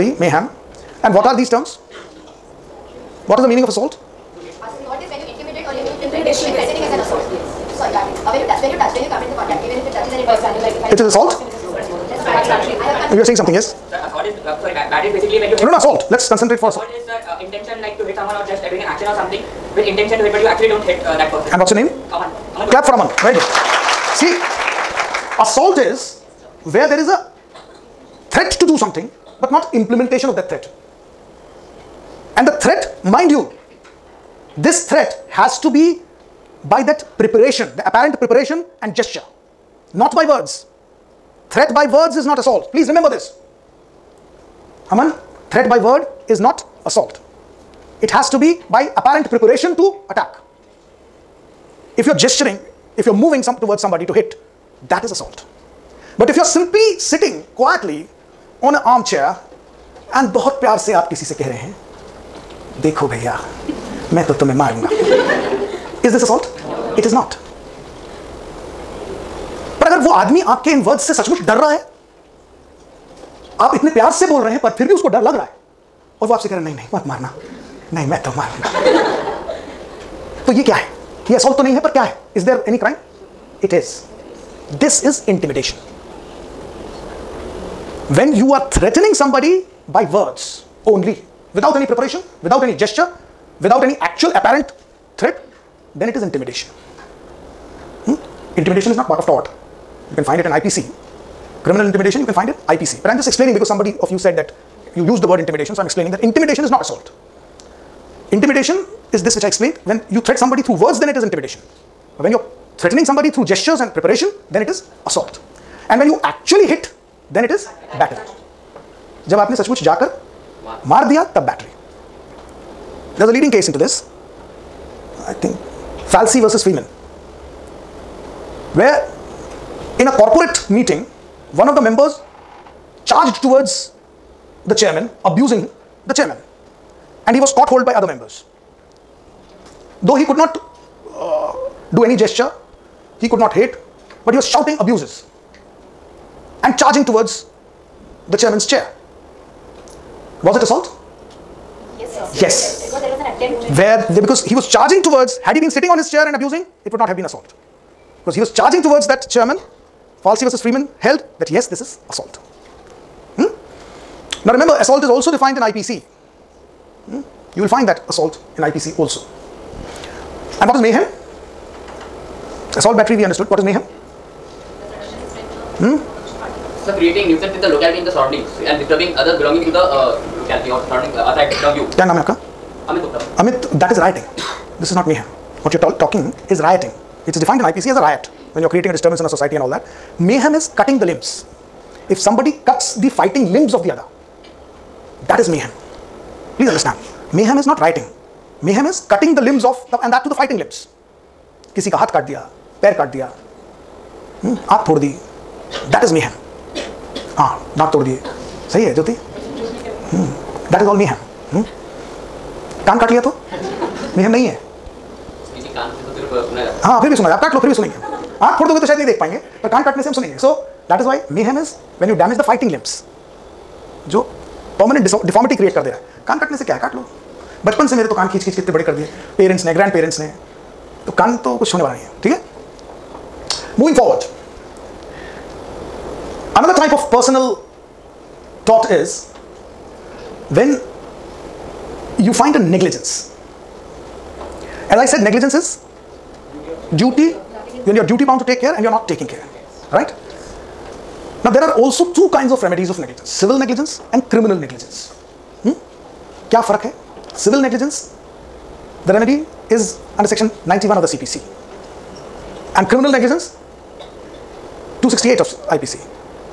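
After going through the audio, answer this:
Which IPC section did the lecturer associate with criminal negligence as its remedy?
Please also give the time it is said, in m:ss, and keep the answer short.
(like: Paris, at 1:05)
268, at 4:25.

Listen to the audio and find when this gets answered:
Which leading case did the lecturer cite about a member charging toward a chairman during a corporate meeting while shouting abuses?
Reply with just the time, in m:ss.
2:06.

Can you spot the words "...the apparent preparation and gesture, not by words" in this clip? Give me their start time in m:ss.
0:37.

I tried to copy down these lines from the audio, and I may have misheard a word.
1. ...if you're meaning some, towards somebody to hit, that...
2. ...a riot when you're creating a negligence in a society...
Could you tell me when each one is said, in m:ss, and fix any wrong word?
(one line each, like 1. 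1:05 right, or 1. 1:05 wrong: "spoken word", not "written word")
1. 0:52 wrong: "moving", not "meaning"
2. 3:07 wrong: "disturbance", not "negligence".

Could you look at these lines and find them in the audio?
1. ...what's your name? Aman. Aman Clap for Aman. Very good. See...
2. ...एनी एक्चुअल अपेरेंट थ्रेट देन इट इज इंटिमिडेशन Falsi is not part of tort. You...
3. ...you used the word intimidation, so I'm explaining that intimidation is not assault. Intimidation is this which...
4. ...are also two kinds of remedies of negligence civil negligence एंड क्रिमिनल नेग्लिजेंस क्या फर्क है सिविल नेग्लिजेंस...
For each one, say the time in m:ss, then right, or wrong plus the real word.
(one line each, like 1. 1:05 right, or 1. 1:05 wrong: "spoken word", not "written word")
1. 0:21 right
2. 1:33 wrong: "Intimidation", not "Falsi"
3. 1:44 right
4. 4:11 right.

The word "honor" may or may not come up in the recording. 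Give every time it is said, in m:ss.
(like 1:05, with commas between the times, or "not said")
not said.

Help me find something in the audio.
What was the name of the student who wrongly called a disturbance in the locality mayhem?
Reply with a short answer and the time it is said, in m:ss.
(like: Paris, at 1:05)
Amit Gupta, at 3:02.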